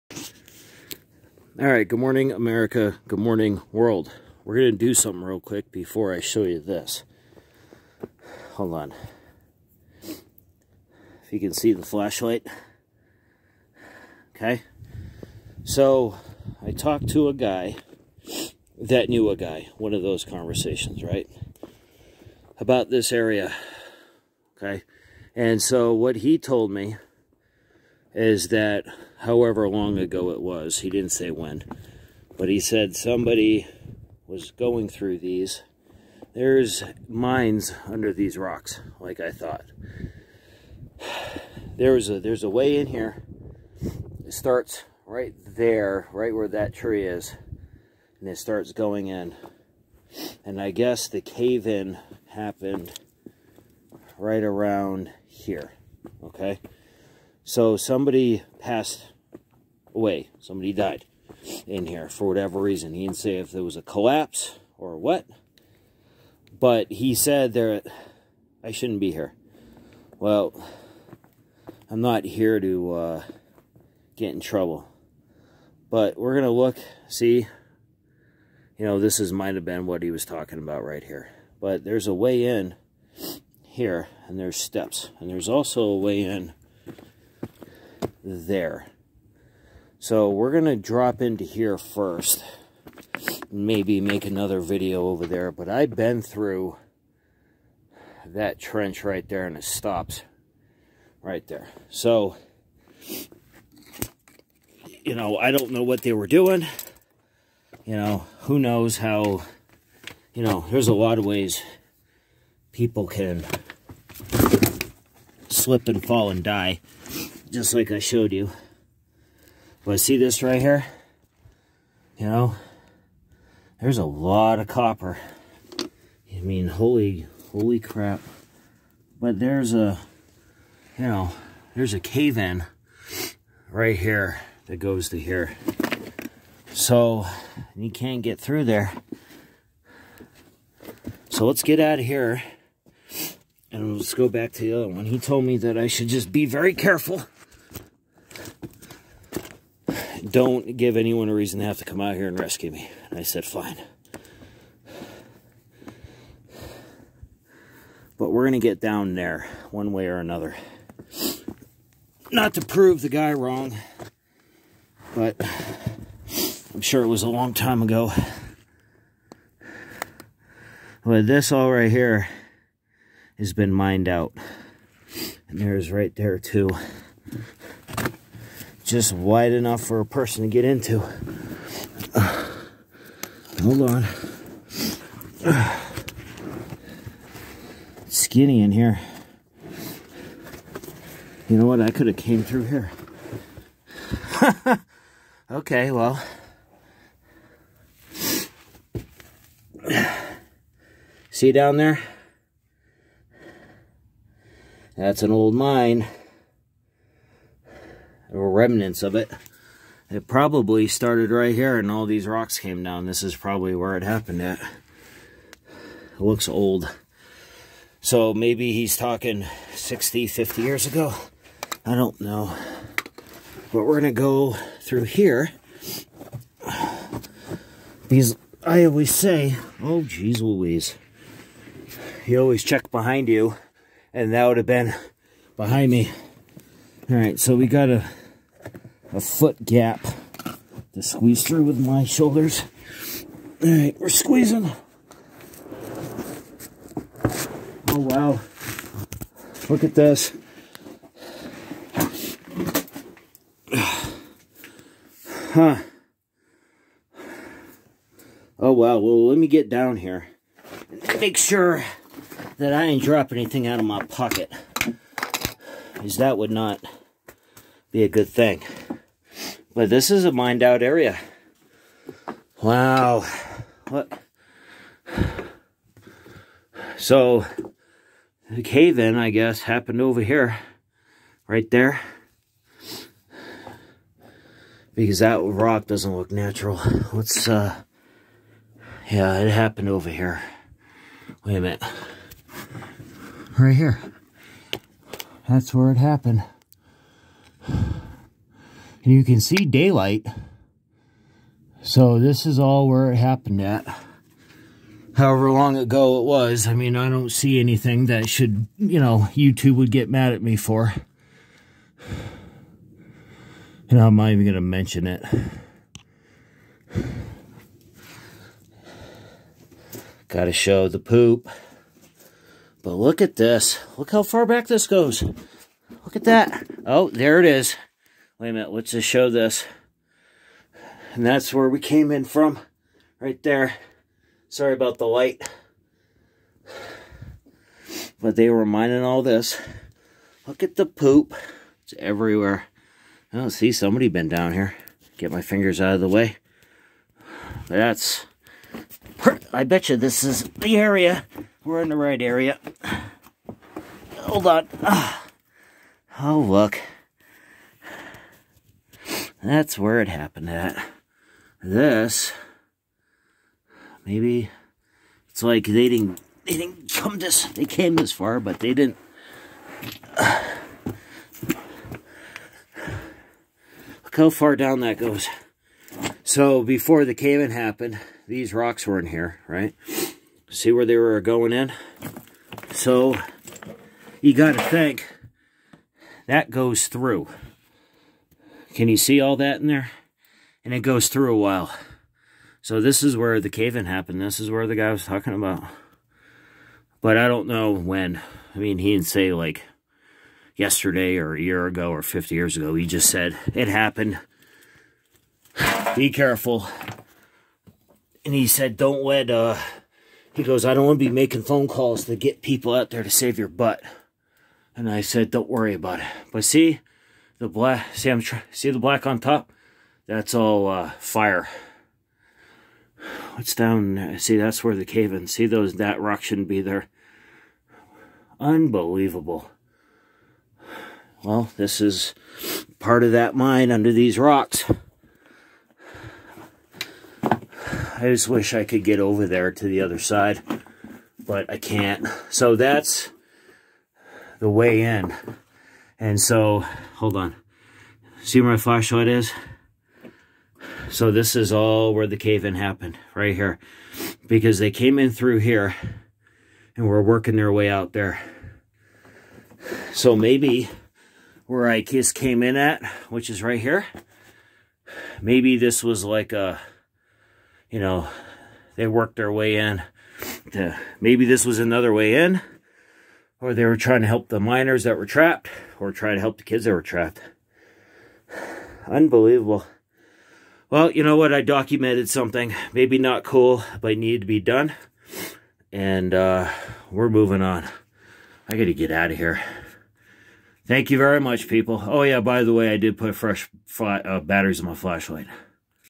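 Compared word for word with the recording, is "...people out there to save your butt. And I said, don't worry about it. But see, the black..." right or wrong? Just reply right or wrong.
right.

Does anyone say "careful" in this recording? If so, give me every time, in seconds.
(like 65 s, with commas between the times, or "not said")
146 s, 406 s.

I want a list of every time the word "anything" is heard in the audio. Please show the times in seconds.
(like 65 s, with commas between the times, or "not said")
263 s, 307 s.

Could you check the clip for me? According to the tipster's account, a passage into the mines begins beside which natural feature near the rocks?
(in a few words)
that tree.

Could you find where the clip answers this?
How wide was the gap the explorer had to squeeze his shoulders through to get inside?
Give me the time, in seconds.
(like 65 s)
239 s.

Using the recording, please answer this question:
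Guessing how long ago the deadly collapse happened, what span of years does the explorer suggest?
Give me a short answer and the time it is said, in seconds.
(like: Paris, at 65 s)
60, 50 years ago, at 219 s.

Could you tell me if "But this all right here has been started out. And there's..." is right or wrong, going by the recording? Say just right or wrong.
wrong.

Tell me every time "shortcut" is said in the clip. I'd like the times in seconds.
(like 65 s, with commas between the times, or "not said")
not said.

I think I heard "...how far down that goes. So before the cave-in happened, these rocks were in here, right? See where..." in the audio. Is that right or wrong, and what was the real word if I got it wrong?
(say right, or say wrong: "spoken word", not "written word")
right.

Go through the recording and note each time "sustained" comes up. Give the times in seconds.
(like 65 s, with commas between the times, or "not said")
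not said.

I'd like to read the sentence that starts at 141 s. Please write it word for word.
So let's get out of here.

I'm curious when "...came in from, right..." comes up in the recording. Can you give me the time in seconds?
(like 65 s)
331 s.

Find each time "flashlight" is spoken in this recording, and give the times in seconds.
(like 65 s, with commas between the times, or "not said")
11 s, 448 s, 494 s.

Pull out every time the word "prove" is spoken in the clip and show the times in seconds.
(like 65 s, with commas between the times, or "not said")
162 s.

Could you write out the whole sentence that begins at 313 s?
And I'm not even going to mention it.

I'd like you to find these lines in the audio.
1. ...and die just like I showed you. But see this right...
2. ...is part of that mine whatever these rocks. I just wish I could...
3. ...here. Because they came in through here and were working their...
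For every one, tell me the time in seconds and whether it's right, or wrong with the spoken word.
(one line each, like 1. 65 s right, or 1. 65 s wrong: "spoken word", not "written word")
1. 116 s right
2. 431 s wrong: "under", not "whatever"
3. 453 s right.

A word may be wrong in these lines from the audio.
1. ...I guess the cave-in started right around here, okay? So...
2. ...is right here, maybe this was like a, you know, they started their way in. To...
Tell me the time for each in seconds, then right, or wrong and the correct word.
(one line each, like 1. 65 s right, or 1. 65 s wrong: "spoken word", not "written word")
1. 50 s wrong: "happened", not "started"
2. 463 s wrong: "worked", not "started".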